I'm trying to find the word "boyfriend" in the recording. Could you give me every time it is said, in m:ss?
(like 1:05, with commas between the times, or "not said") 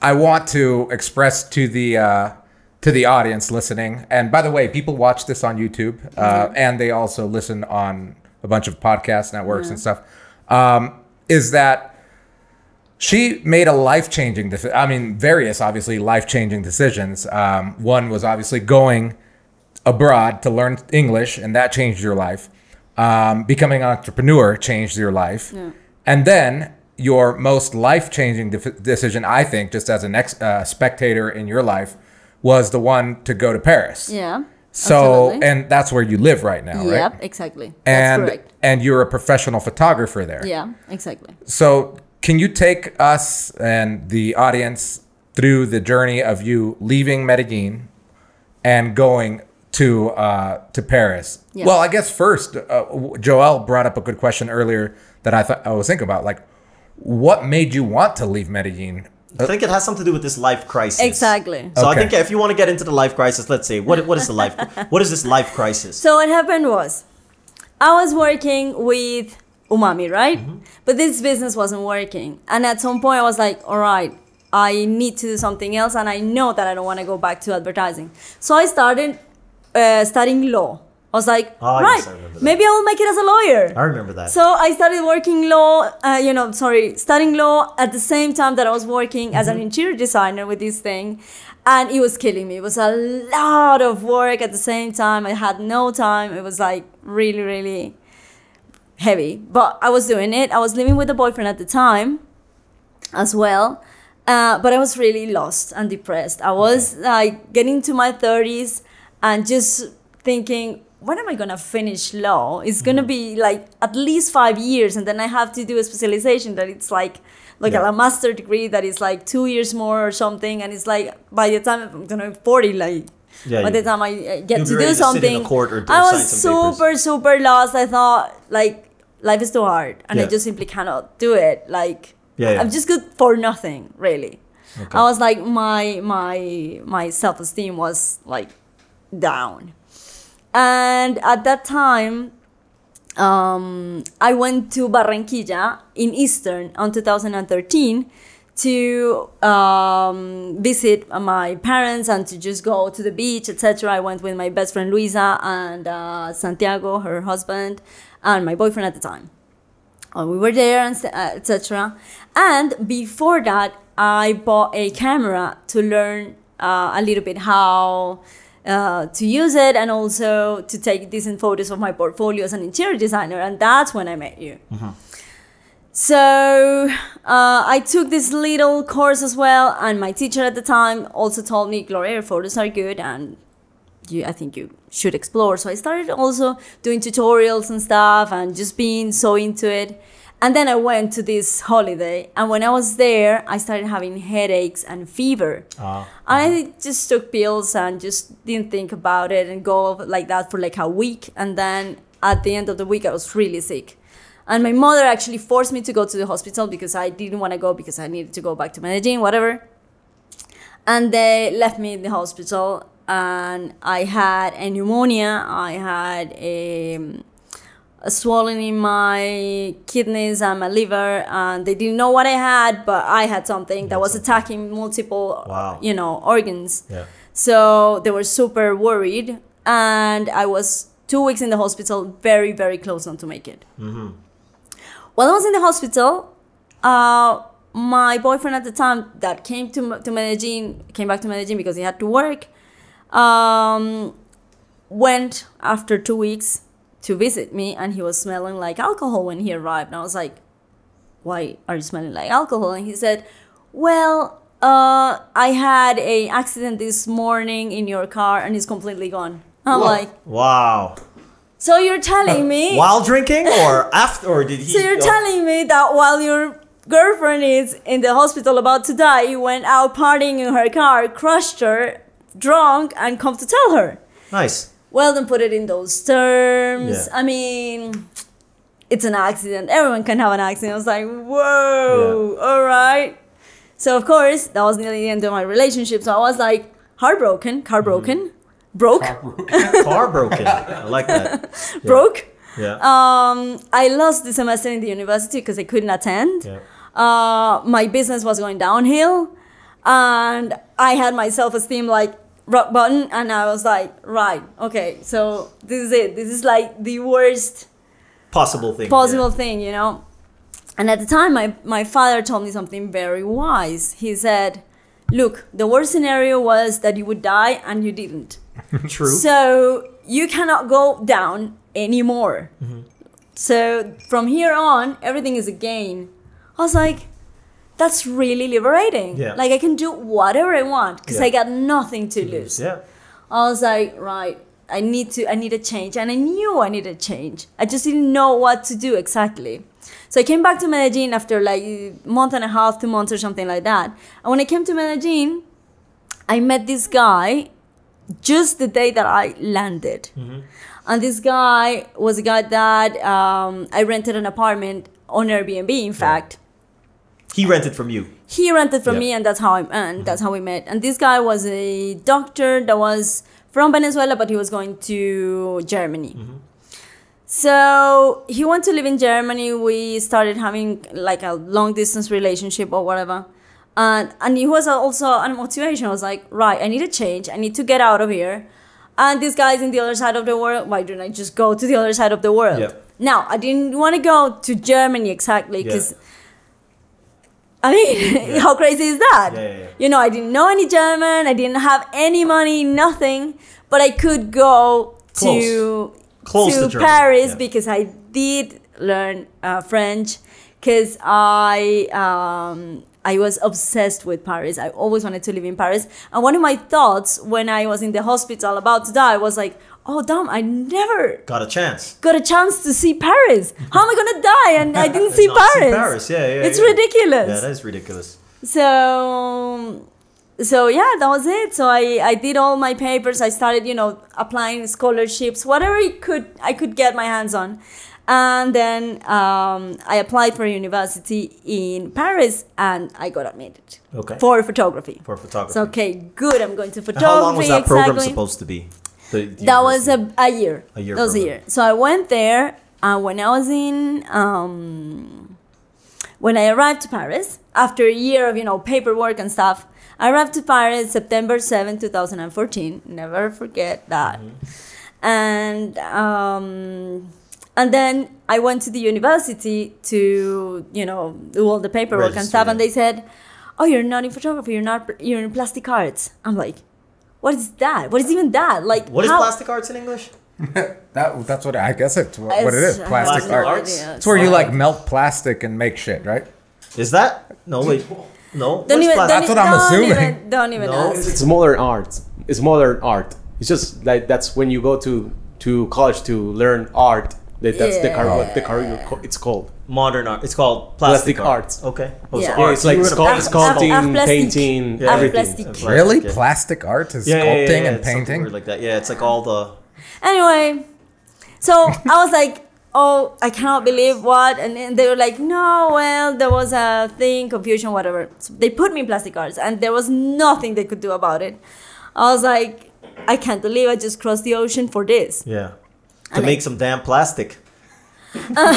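1:41, 2:38, 3:58.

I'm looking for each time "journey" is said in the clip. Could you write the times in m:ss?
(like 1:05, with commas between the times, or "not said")
0:45.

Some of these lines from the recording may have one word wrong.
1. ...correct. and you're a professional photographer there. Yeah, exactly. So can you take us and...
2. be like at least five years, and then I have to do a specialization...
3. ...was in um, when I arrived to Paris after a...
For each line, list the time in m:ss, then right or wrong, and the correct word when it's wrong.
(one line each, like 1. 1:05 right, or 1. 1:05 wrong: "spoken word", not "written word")
1. 0:38 right
2. 1:53 right
3. 7:23 right.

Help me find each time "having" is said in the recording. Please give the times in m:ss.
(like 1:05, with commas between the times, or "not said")
3:13, 6:10.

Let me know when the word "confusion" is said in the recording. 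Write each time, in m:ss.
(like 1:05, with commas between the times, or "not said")
8:27.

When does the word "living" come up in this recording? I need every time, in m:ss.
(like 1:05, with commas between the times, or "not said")
1:40.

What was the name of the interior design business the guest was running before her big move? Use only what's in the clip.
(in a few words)
Umami.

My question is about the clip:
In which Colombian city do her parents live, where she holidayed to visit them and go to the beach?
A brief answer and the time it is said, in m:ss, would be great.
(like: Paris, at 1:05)
Barranquilla, at 2:24.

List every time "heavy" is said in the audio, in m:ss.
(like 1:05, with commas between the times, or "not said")
1:38.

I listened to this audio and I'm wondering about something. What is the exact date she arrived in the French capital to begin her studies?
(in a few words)
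September 7, 2014.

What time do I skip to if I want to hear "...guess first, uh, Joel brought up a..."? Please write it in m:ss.
0:51.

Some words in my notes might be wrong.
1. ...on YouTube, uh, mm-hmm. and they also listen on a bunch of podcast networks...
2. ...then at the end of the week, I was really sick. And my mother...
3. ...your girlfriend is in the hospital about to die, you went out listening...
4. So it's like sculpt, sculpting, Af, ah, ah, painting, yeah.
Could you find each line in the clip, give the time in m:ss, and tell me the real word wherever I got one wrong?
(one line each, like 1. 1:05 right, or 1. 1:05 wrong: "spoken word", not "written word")
1. 0:05 right
2. 3:21 right
3. 4:26 wrong: "partying", not "listening"
4. 8:12 right.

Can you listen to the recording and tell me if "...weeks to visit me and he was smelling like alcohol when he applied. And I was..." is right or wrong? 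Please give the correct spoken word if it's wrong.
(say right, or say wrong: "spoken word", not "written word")
wrong: "arrived", not "applied".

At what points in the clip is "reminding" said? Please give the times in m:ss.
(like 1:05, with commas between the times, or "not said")
not said.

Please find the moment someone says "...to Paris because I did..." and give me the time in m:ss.
6:36.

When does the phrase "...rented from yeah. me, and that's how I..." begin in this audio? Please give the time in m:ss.
5:58.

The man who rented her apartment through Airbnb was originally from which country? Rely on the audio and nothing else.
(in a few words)
Venezuela.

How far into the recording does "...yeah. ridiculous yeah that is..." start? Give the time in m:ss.
6:56.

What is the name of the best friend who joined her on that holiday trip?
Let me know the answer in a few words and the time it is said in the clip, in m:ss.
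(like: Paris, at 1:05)
Luisa, at 2:34.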